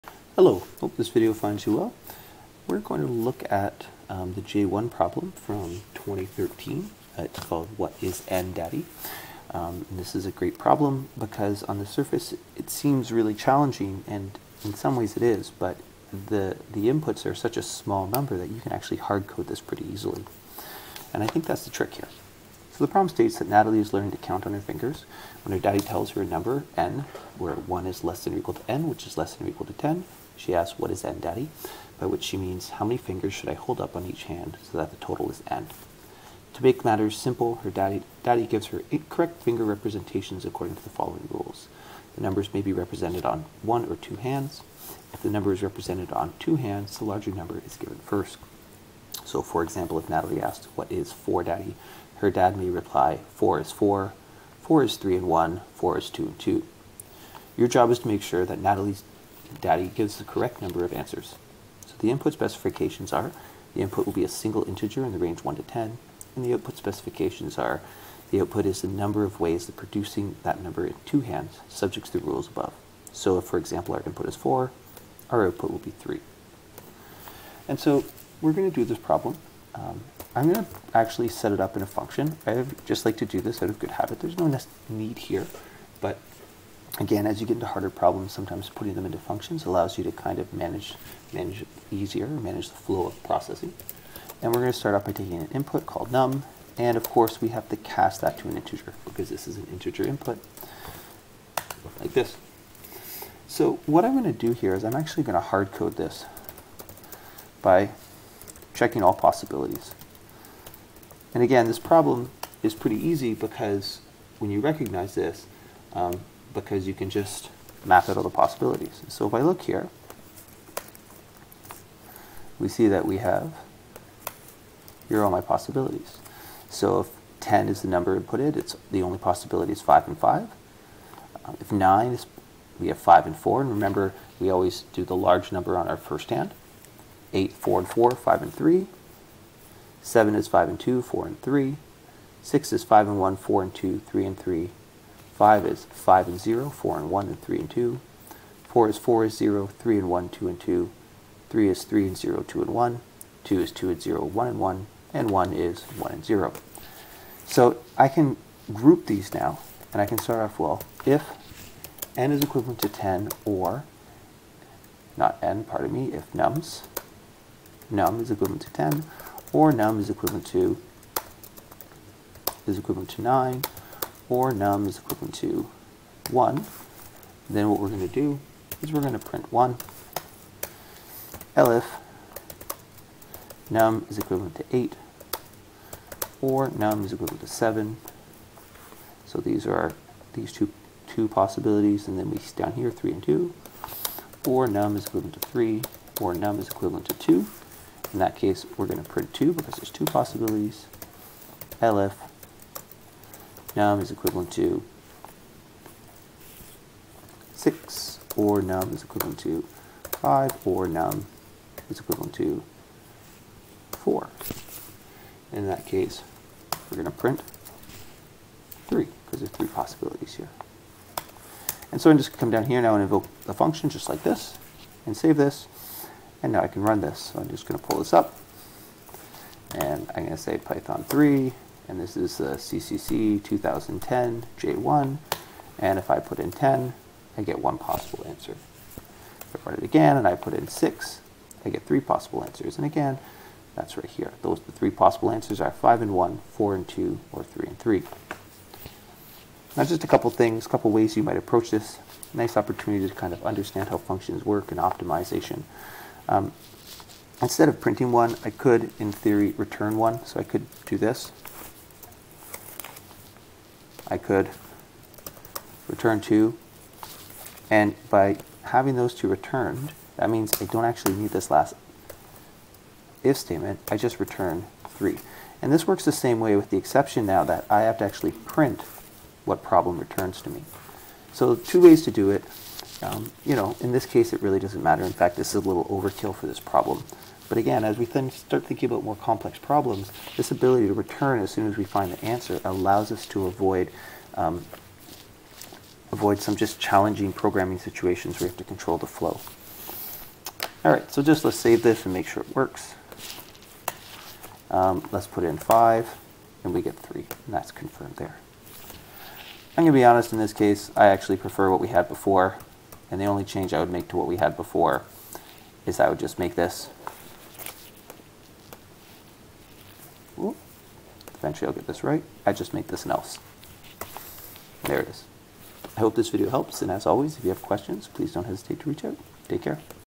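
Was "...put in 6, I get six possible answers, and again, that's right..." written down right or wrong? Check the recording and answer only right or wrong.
wrong.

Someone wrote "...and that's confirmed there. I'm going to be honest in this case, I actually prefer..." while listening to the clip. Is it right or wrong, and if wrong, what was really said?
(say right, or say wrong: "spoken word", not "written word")
right.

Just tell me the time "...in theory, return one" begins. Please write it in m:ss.
4:18.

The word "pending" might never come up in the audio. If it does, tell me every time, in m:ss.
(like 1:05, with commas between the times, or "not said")
not said.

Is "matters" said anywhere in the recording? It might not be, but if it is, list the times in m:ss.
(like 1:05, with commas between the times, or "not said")
0:36, 4:44.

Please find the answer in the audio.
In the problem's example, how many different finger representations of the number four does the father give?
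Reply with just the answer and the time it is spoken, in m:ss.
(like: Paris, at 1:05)
3, at 1:15.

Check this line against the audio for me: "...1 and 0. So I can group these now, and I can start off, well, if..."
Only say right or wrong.
right.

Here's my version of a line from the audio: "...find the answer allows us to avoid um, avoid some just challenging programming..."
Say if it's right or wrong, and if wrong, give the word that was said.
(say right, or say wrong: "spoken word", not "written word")
right.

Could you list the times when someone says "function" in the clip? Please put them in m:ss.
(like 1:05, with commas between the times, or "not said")
1:21, 1:29, 3:43, 4:13.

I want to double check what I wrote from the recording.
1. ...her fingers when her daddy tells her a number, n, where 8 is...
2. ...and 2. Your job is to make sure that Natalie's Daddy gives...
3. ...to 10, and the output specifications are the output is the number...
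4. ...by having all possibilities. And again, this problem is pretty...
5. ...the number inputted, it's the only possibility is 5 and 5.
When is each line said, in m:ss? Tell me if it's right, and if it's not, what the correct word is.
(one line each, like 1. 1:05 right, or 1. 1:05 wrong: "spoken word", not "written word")
1. 0:24 wrong: "1", not "8"
2. 0:56 right
3. 1:05 right
4. 1:47 wrong: "checking", not "having"
5. 2:07 right.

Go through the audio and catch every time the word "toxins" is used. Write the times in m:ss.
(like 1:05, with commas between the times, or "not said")
not said.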